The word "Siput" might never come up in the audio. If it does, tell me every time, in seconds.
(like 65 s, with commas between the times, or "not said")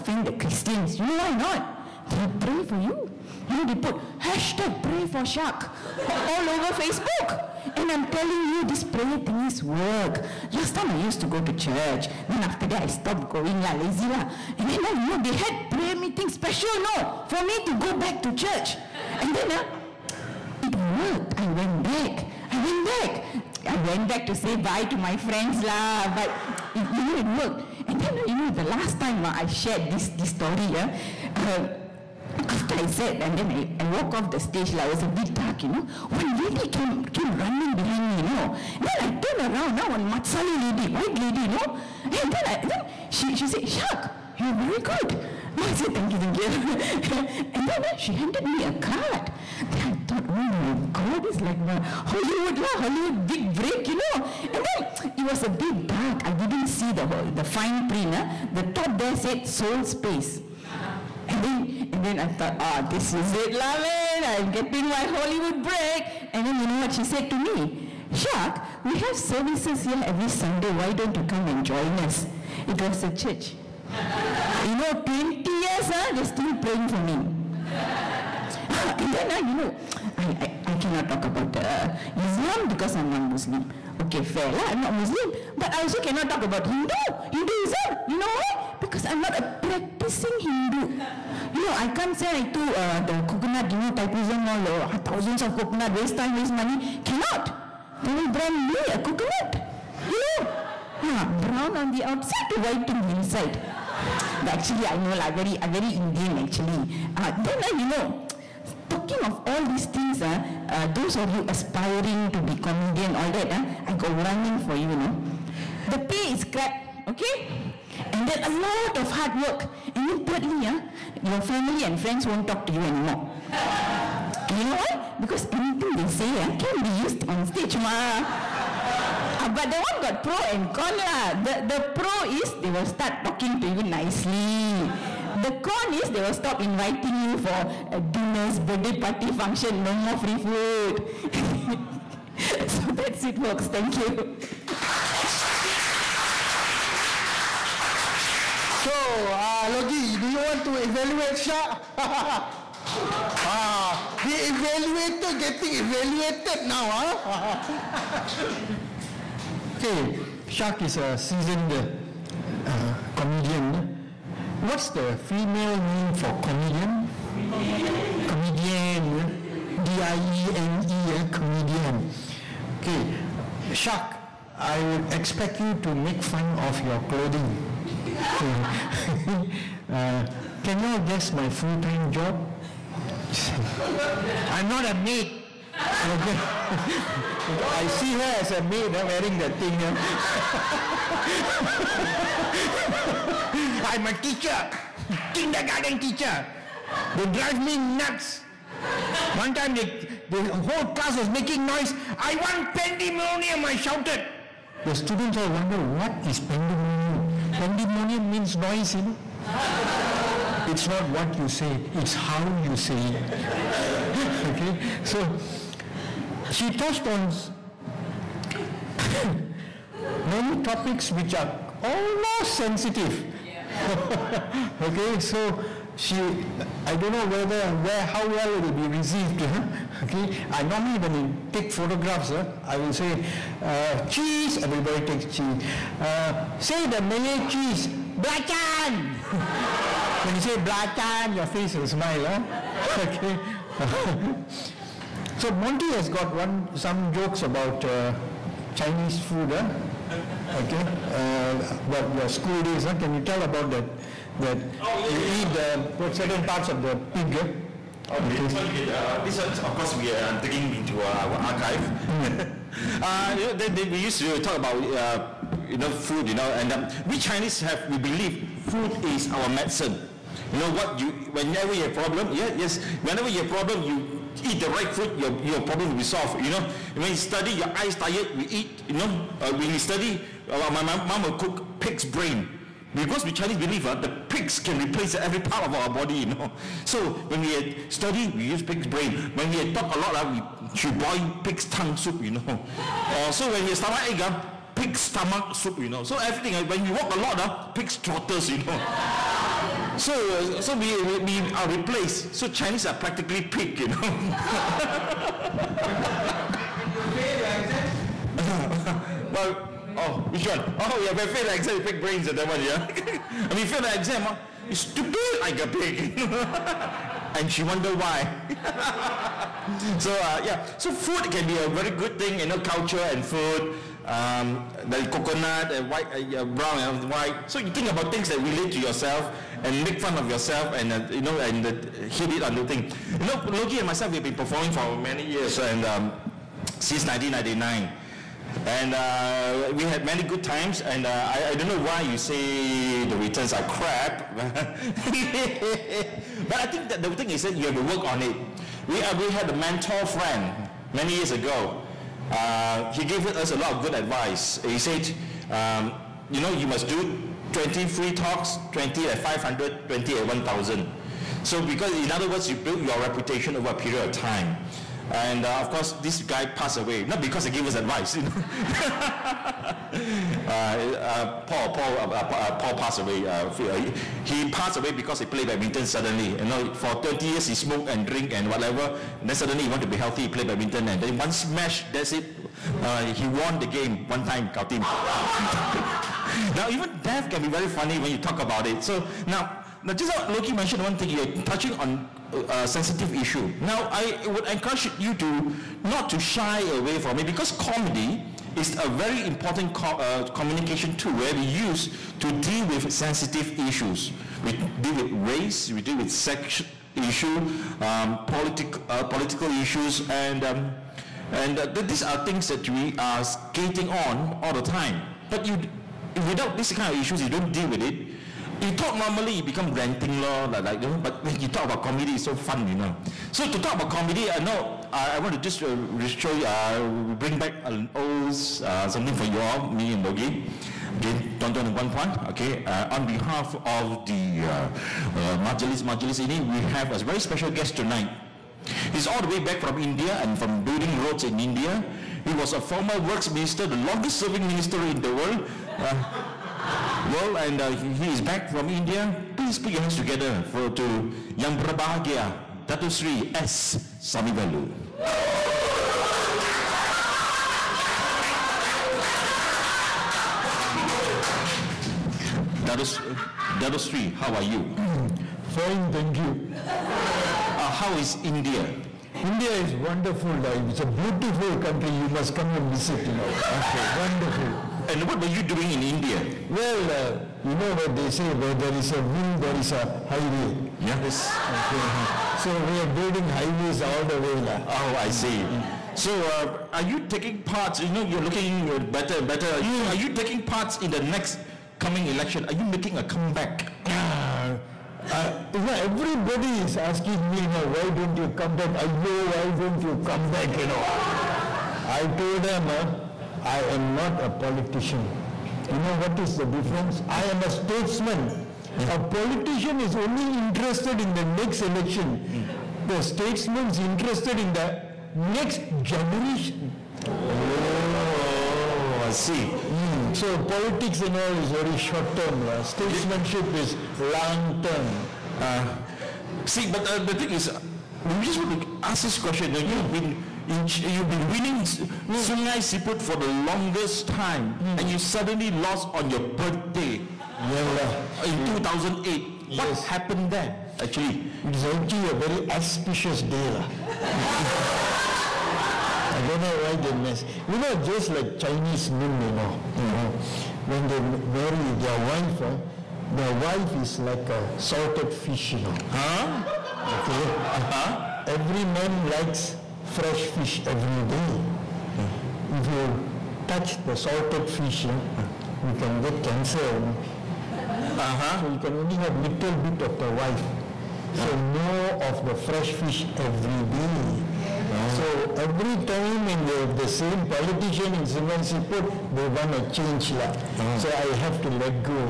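532 s, 578 s.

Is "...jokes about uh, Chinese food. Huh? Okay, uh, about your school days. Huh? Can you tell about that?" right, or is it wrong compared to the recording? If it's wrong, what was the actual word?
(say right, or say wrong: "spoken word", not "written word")
right.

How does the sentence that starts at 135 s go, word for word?
The con is they will stop inviting you for dinners, birthday party function, no more free food.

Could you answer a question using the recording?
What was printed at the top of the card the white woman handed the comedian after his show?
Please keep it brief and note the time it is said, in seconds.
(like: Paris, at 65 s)
Soul Space, at 59 s.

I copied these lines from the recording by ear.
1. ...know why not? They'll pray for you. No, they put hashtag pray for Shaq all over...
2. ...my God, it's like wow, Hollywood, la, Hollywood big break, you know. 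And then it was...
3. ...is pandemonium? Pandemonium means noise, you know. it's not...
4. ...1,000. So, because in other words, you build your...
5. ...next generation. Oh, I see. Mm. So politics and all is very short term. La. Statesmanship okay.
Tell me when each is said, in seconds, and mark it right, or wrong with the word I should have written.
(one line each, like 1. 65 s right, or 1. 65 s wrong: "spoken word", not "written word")
1. 1 s right
2. 50 s right
3. 206 s right
4. 360 s right
5. 515 s right.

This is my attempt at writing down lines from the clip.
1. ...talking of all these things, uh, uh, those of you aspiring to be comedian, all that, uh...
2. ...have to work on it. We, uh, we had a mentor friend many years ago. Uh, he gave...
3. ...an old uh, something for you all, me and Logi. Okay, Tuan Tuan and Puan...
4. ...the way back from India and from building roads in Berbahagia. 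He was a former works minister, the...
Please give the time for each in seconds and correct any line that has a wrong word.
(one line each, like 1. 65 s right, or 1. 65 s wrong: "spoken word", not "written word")
1. 108 s right
2. 347 s right
3. 427 s right
4. 439 s wrong: "India", not "Berbahagia".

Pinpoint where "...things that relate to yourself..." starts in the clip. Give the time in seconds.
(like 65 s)
328 s.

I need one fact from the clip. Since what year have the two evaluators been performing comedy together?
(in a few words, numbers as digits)
1999.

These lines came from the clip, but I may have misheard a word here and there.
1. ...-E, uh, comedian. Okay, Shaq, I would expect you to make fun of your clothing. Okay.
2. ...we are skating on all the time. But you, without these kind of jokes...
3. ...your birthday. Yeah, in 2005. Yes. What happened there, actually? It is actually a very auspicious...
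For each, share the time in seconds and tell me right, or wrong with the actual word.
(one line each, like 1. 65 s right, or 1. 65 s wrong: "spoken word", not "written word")
1. 171 s right
2. 412 s wrong: "issues", not "jokes"
3. 536 s wrong: "2008", not "2005".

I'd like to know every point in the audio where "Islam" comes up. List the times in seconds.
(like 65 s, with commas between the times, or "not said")
82 s.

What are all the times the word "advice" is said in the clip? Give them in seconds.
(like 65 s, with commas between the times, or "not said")
353 s, 367 s.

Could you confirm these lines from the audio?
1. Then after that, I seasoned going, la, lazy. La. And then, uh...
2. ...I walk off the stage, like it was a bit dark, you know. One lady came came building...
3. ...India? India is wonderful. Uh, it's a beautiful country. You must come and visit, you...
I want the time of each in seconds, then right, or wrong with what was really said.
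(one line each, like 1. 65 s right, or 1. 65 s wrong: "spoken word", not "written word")
1. 12 s wrong: "stopped", not "seasoned"
2. 33 s wrong: "running", not "building"
3. 468 s right.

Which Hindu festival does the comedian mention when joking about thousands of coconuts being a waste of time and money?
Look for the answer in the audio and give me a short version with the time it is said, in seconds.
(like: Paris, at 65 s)
Thaipusam, at 93 s.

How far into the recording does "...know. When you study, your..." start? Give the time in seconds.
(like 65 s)
276 s.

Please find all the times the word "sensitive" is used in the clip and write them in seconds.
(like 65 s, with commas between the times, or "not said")
222 s, 392 s, 402 s.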